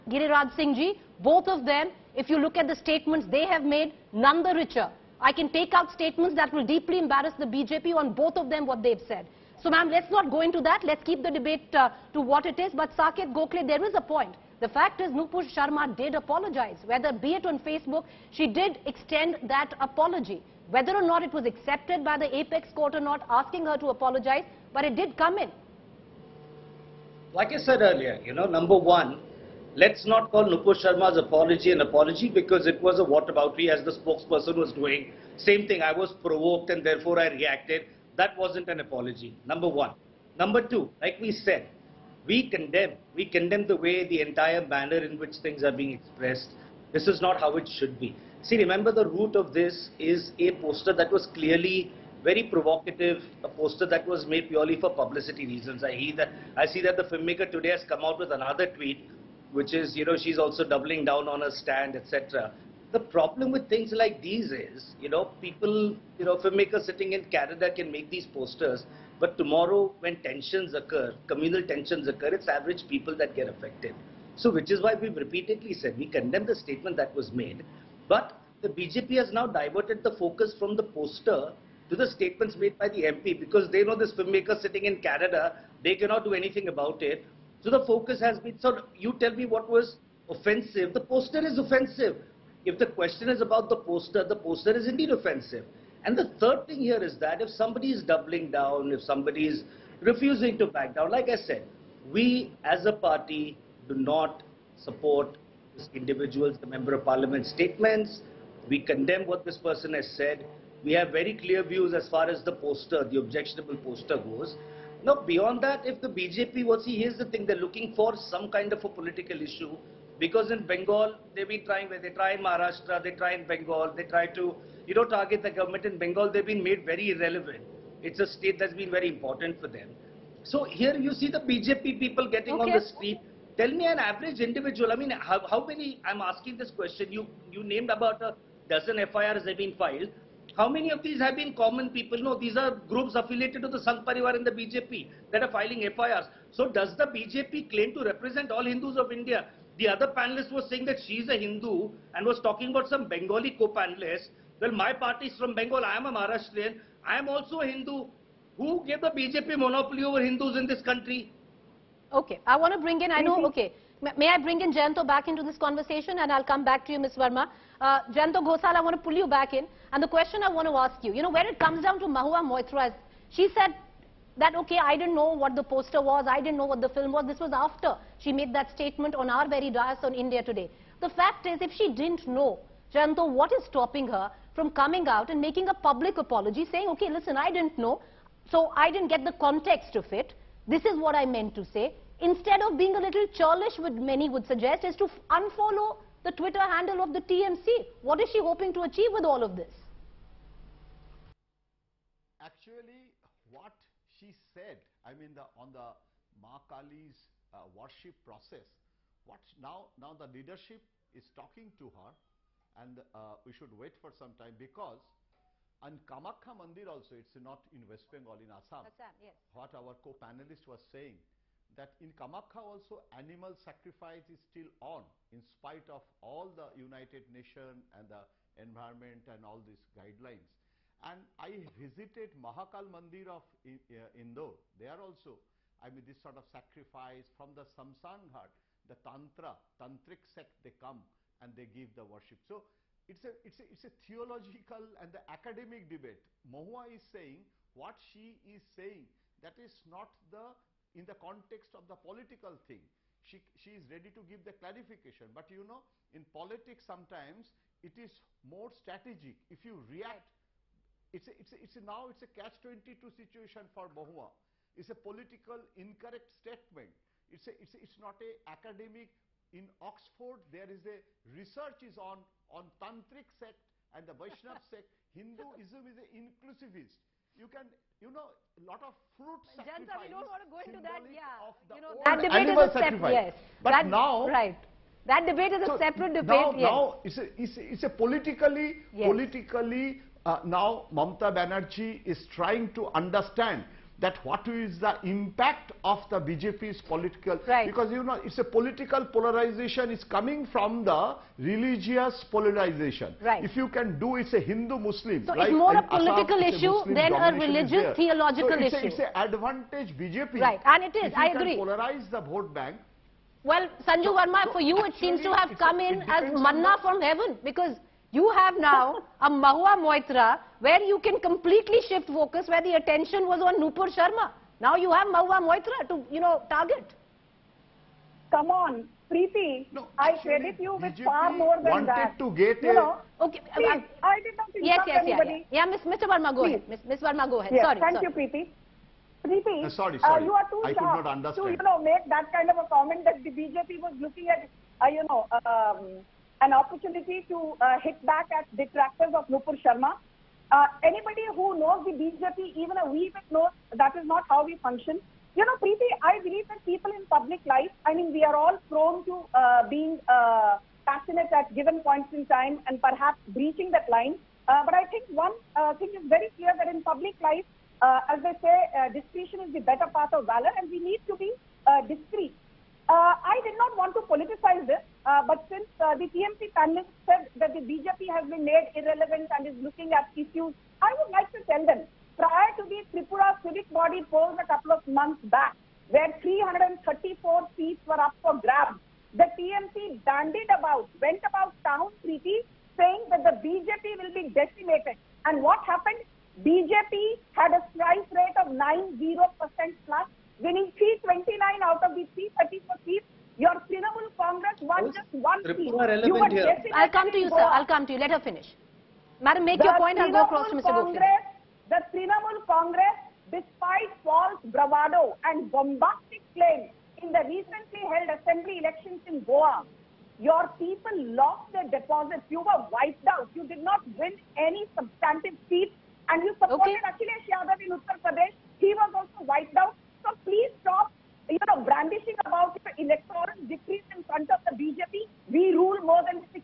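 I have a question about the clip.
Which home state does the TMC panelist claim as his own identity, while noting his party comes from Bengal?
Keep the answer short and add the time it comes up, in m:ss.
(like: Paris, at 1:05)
Maharashtra, at 2:36.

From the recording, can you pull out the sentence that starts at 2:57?
This was after she made that statement on our very dais on India Today.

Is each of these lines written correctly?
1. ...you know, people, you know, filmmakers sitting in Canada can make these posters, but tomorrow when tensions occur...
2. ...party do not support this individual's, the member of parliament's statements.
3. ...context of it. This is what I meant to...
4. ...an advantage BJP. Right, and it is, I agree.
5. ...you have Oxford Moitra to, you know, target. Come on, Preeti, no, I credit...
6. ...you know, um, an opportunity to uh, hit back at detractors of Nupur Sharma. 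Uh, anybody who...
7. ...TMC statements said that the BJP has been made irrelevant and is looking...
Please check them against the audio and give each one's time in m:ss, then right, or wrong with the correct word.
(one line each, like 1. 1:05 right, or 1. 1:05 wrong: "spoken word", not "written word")
1. 1:05 right
2. 1:42 right
3. 3:09 right
4. 5:08 right
5. 5:24 wrong: "Mahua", not "Oxford"
6. 5:44 right
7. 6:16 wrong: "panelists", not "statements".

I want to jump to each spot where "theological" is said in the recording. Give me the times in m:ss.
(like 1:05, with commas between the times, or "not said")
4:04, 5:07.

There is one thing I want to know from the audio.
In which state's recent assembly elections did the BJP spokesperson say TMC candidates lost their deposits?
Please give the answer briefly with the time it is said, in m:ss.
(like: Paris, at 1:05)
Goa, at 6:59.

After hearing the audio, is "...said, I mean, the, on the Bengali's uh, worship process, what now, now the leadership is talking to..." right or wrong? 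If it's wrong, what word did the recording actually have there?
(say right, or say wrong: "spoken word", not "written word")
wrong: "Mahakali", not "Bengali".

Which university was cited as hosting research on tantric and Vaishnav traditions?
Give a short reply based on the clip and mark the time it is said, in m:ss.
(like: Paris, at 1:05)
Oxford, at 4:29.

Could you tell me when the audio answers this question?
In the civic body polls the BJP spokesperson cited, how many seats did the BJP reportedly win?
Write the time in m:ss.
6:40.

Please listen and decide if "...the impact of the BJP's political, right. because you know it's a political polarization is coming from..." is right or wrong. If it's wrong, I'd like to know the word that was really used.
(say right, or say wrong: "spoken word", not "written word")
right.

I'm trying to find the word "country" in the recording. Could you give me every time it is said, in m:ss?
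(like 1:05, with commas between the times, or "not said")
2:40.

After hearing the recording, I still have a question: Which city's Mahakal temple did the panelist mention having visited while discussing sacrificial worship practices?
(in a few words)
Indore.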